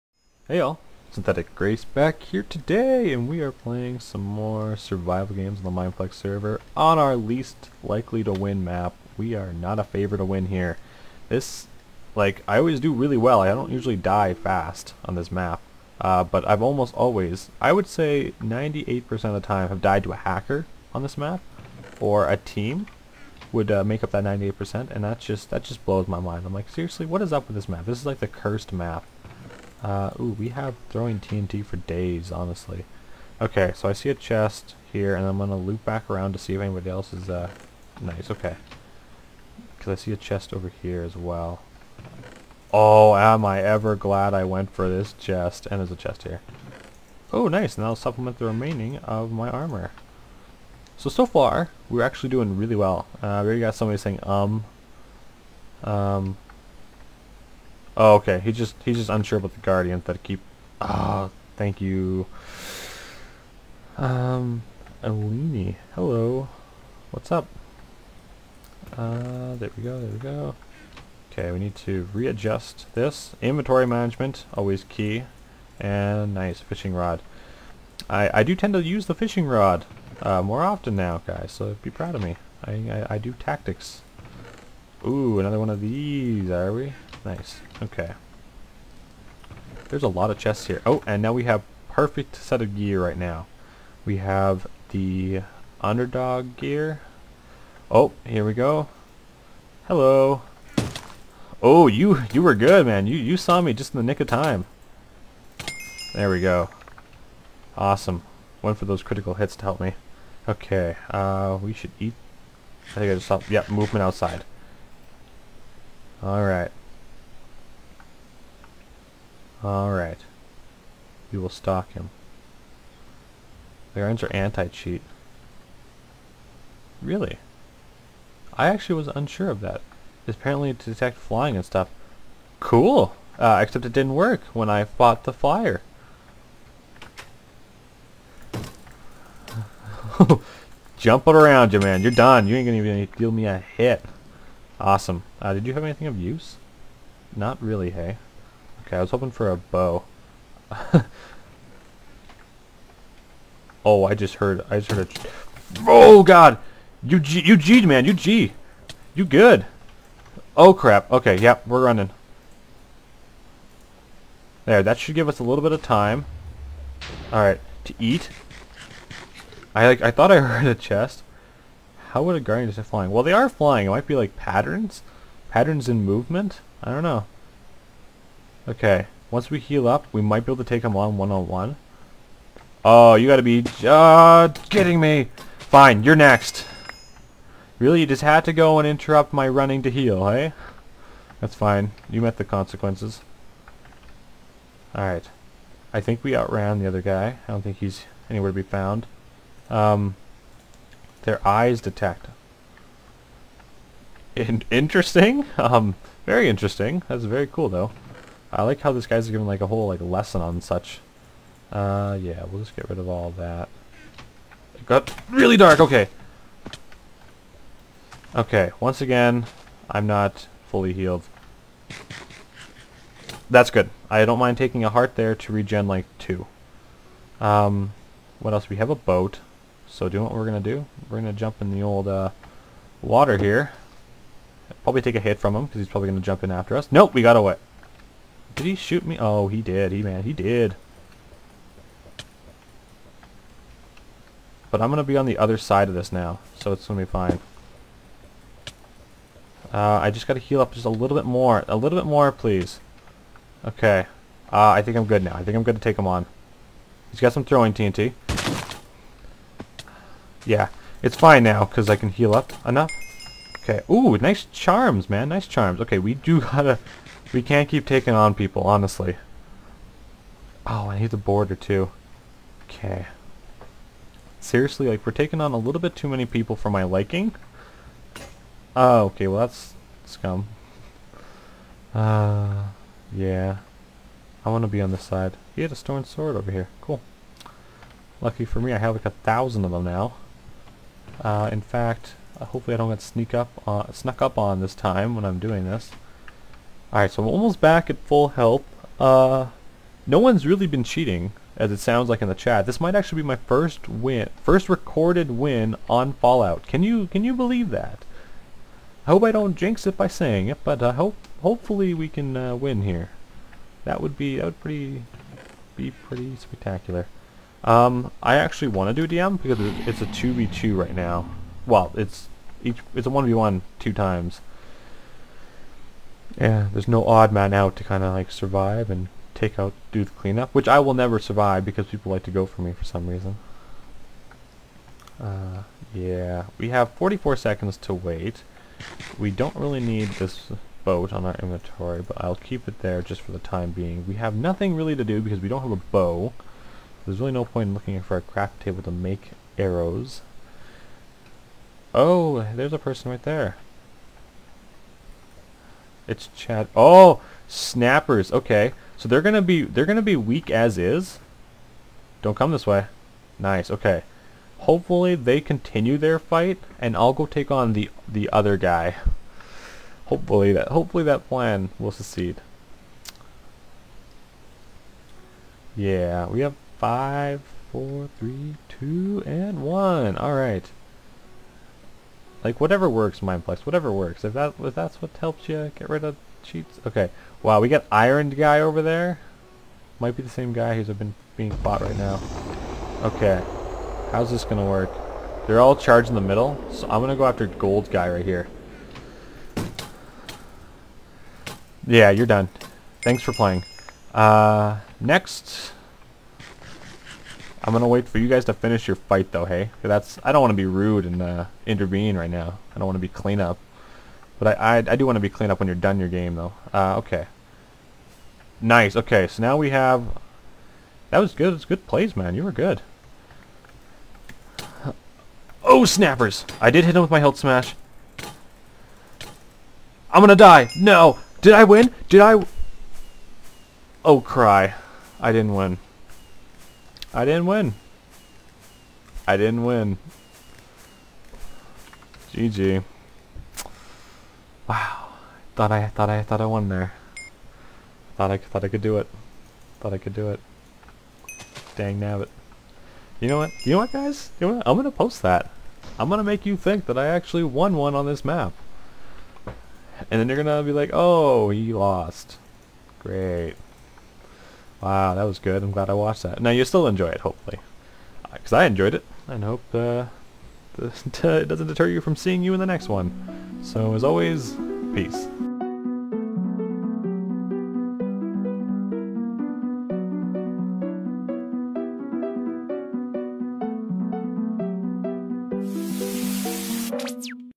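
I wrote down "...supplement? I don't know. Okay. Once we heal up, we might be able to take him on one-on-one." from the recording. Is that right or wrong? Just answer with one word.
wrong.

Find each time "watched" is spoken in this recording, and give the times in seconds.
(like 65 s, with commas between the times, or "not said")
465 s.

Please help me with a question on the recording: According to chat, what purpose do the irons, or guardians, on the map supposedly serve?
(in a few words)
anti-cheat.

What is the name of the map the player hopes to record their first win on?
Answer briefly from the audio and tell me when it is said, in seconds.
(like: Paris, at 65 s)
Fallout, at 306 s.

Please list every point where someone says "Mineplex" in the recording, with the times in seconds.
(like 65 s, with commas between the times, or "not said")
5 s, 383 s.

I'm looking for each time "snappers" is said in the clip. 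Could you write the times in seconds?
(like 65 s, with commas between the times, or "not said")
357 s, 425 s.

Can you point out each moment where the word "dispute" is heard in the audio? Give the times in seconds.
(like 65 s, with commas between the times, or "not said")
not said.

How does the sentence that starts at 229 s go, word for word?
So do what we're going to do, we're going to jump in the old uh, water here.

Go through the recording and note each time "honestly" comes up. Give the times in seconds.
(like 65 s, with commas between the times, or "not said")
32 s, 268 s.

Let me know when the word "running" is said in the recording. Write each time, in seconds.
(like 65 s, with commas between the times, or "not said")
161 s, 189 s.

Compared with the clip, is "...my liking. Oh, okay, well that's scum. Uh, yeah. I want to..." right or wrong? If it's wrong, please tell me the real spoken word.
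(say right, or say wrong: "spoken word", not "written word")
right.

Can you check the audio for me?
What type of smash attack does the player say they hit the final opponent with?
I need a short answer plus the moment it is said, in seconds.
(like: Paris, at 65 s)
hilt smash, at 427 s.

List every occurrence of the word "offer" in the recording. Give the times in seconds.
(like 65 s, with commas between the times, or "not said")
not said.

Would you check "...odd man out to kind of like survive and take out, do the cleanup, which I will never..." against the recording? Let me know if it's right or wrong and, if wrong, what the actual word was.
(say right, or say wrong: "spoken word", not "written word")
right.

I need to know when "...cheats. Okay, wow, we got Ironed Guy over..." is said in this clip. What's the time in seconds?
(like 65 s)
386 s.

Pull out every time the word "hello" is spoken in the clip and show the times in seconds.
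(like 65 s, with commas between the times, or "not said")
65 s, 99 s.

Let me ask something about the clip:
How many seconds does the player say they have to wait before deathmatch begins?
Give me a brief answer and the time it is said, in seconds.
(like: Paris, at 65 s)
44 seconds, at 336 s.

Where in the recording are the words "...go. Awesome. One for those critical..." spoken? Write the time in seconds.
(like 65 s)
106 s.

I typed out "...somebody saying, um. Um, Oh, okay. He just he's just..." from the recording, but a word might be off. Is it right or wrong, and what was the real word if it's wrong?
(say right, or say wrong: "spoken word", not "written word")
right.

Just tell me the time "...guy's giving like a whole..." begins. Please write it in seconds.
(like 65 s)
209 s.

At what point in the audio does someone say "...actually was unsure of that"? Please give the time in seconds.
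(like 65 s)
128 s.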